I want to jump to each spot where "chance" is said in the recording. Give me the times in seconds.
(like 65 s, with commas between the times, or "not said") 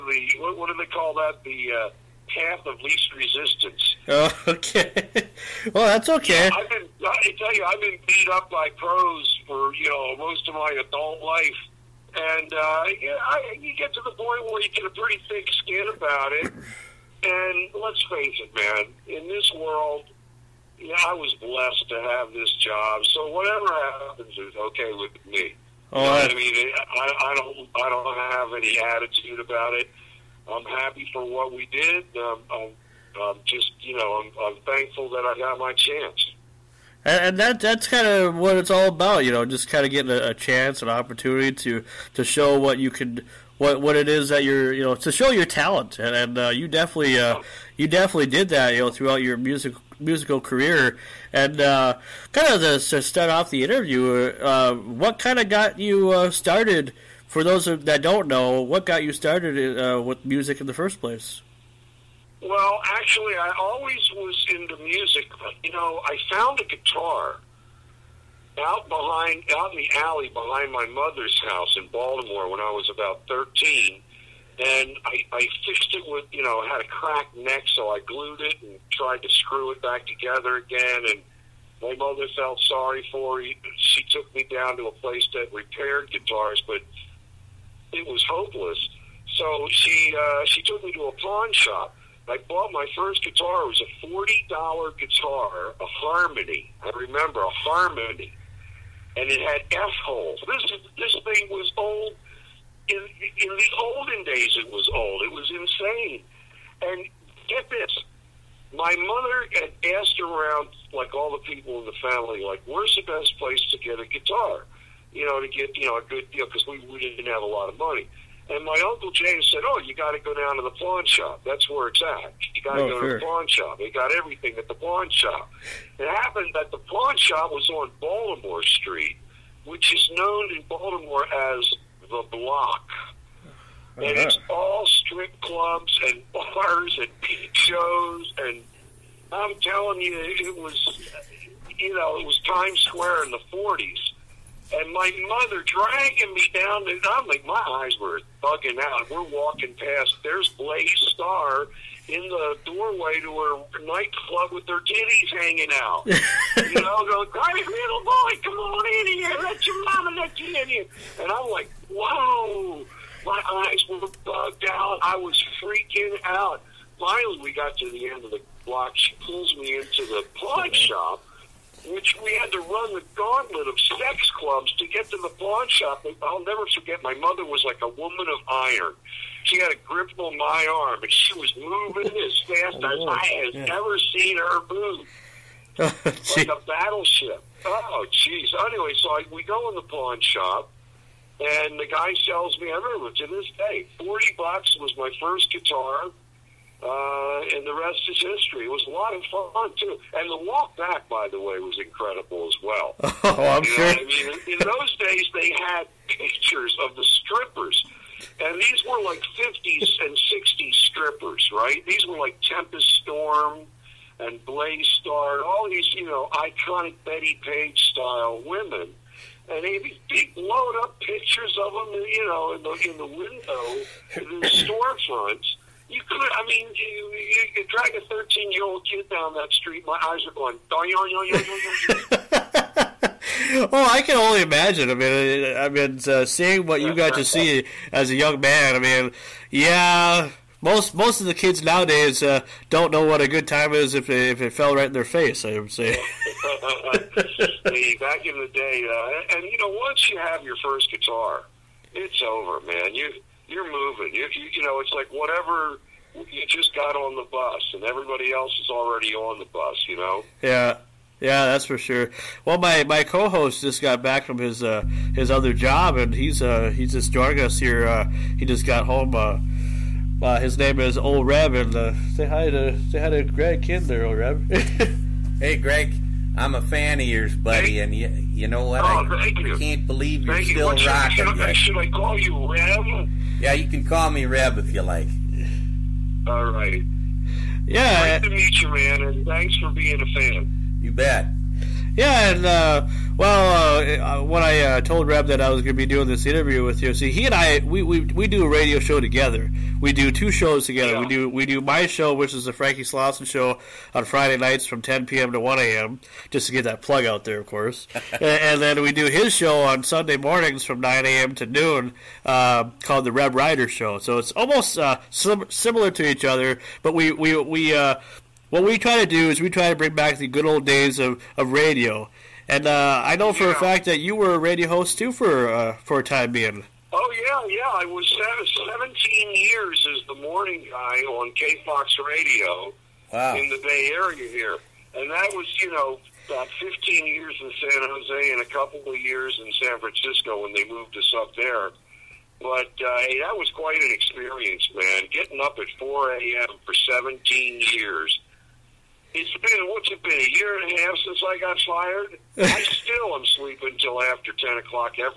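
35 s, 40 s.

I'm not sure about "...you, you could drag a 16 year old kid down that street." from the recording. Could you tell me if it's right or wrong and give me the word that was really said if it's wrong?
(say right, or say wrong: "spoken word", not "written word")
wrong: "13", not "16".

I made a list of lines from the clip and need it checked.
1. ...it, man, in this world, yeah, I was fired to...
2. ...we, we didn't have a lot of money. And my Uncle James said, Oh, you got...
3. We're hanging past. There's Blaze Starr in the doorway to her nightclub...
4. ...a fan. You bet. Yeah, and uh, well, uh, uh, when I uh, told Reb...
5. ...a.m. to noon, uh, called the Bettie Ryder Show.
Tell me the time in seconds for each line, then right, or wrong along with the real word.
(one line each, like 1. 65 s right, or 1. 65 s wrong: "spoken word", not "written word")
1. 18 s wrong: "blessed", not "fired"
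2. 116 s right
3. 149 s wrong: "walking", not "hanging"
4. 290 s right
5. 311 s wrong: "Reb", not "Bettie".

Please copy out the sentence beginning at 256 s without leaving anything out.
You just got on the bus, and everybody else is already on the bus.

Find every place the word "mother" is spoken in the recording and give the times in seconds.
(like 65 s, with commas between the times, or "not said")
70 s, 81 s, 109 s, 145 s, 177 s.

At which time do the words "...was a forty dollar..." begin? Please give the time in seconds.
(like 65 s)
93 s.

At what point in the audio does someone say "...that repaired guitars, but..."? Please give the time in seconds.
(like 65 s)
85 s.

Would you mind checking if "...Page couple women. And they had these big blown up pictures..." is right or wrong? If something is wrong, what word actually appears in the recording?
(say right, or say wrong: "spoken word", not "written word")
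wrong: "style", not "couple".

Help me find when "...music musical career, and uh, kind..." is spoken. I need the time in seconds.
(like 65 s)
49 s.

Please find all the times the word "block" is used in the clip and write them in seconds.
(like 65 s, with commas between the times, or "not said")
132 s, 168 s.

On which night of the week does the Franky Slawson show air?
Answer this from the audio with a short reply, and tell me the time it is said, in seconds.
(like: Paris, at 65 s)
Friday nights, at 304 s.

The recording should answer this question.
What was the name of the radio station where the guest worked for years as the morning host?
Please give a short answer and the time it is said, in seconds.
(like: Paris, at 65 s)
K Fox, at 331 s.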